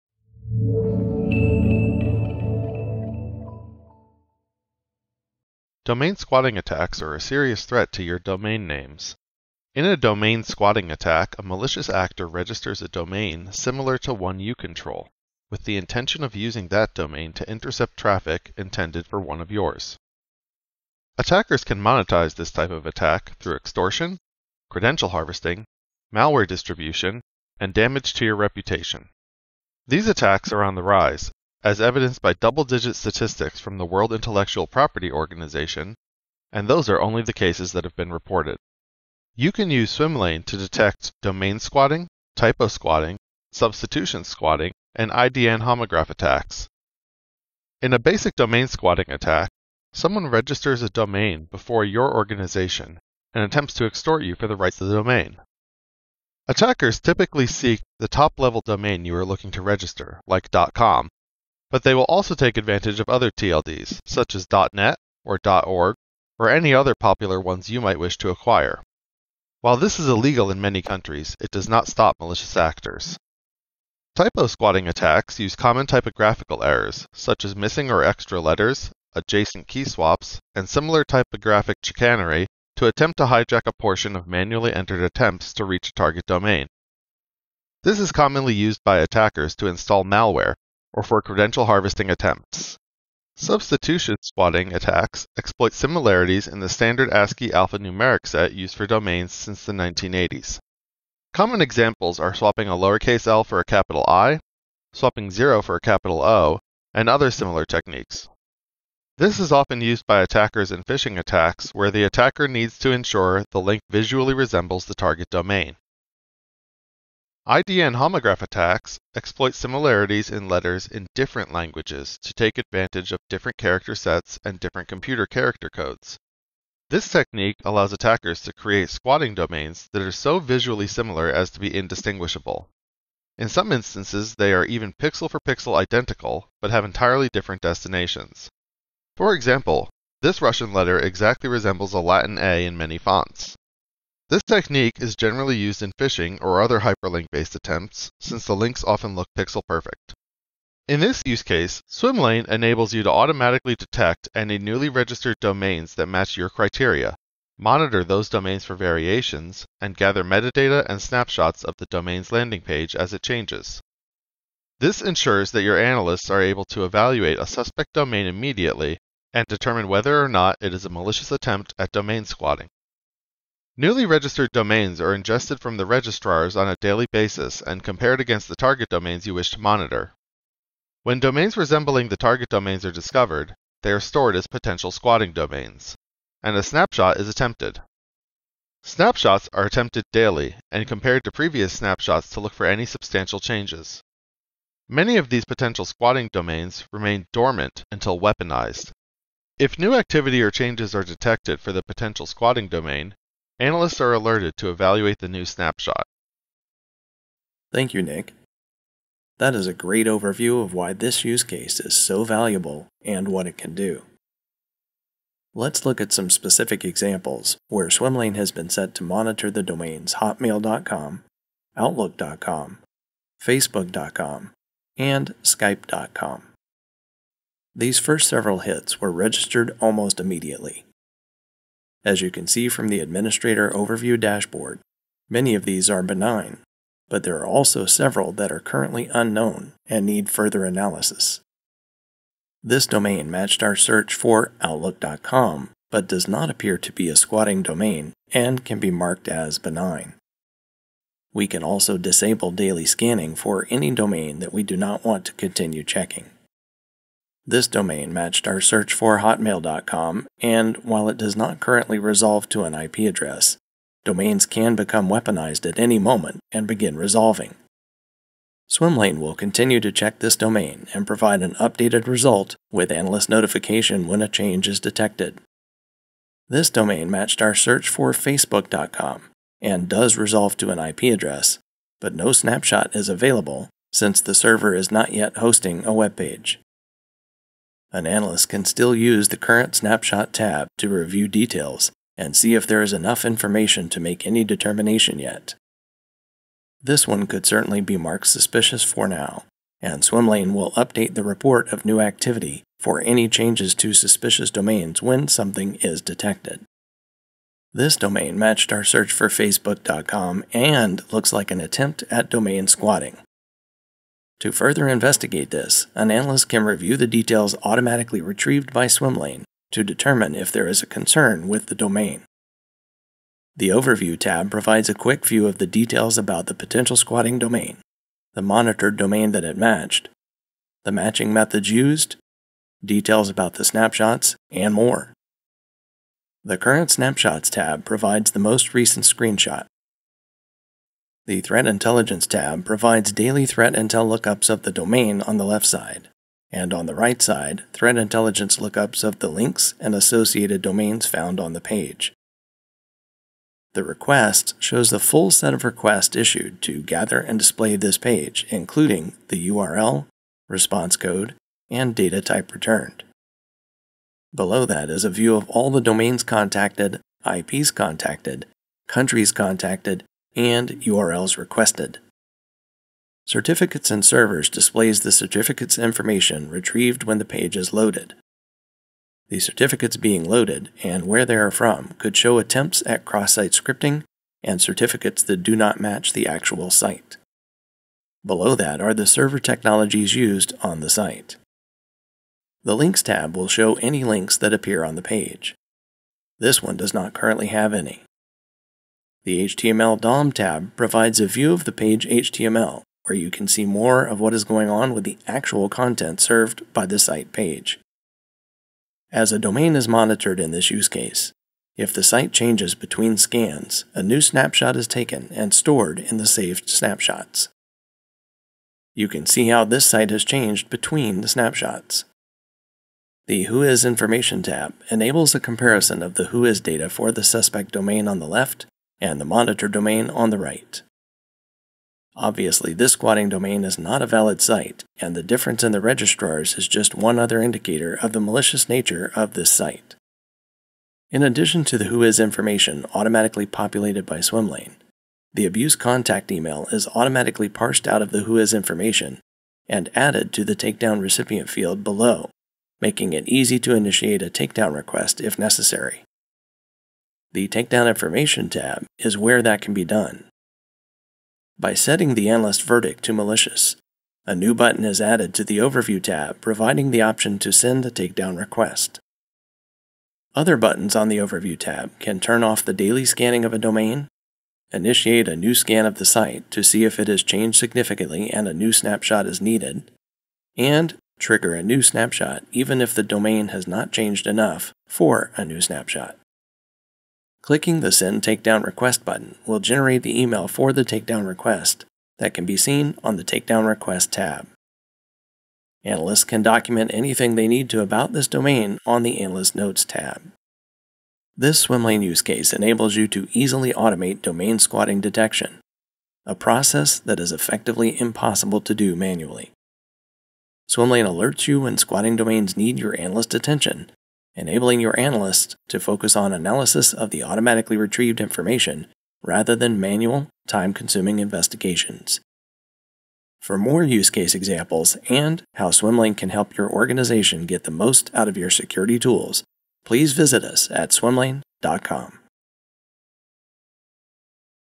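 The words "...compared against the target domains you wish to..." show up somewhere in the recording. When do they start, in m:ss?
2:57.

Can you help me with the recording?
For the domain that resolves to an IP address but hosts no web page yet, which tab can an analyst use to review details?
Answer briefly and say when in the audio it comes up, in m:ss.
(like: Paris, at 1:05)
Current Snapshot, at 4:49.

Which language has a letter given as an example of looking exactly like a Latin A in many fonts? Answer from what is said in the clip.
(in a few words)
Russian.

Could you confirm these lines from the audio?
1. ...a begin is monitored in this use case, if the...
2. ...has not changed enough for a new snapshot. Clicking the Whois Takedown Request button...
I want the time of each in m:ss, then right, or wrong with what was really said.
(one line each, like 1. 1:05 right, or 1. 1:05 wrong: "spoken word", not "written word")
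1. 6:49 wrong: "domain", not "begin"
2. 8:03 wrong: "Send", not "Whois".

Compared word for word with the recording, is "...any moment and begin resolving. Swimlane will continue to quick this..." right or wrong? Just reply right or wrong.
wrong.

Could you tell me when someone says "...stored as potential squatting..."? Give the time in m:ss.
3:03.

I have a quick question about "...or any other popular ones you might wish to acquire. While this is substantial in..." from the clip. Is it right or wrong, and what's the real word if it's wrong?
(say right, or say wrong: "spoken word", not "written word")
wrong: "illegal", not "substantial".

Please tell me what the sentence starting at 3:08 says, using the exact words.
Snapshots are attempted daily and compared to previous snapshots to look for any substantial changes.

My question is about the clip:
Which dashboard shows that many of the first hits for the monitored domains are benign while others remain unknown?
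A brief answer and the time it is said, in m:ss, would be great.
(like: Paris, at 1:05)
Administrator Overview, at 3:52.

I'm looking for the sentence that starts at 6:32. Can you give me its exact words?
The Links tab will show any links that appear on the page.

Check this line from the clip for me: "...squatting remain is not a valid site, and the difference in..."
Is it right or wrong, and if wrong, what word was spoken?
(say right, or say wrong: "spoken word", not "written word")
wrong: "domain", not "remain".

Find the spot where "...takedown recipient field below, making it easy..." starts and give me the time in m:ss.
7:30.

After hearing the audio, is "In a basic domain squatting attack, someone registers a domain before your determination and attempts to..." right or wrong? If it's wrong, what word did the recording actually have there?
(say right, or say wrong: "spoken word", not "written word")
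wrong: "organization", not "determination".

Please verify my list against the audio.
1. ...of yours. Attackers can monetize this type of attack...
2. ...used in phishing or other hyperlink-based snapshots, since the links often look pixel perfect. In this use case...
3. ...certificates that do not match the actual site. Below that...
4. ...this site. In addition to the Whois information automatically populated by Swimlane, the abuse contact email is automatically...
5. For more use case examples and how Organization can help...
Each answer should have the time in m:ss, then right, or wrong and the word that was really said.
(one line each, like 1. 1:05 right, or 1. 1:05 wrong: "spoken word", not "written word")
1. 0:19 right
2. 2:25 wrong: "attempts", not "snapshots"
3. 6:24 right
4. 7:19 right
5. 8:43 wrong: "Swimlane", not "Organization".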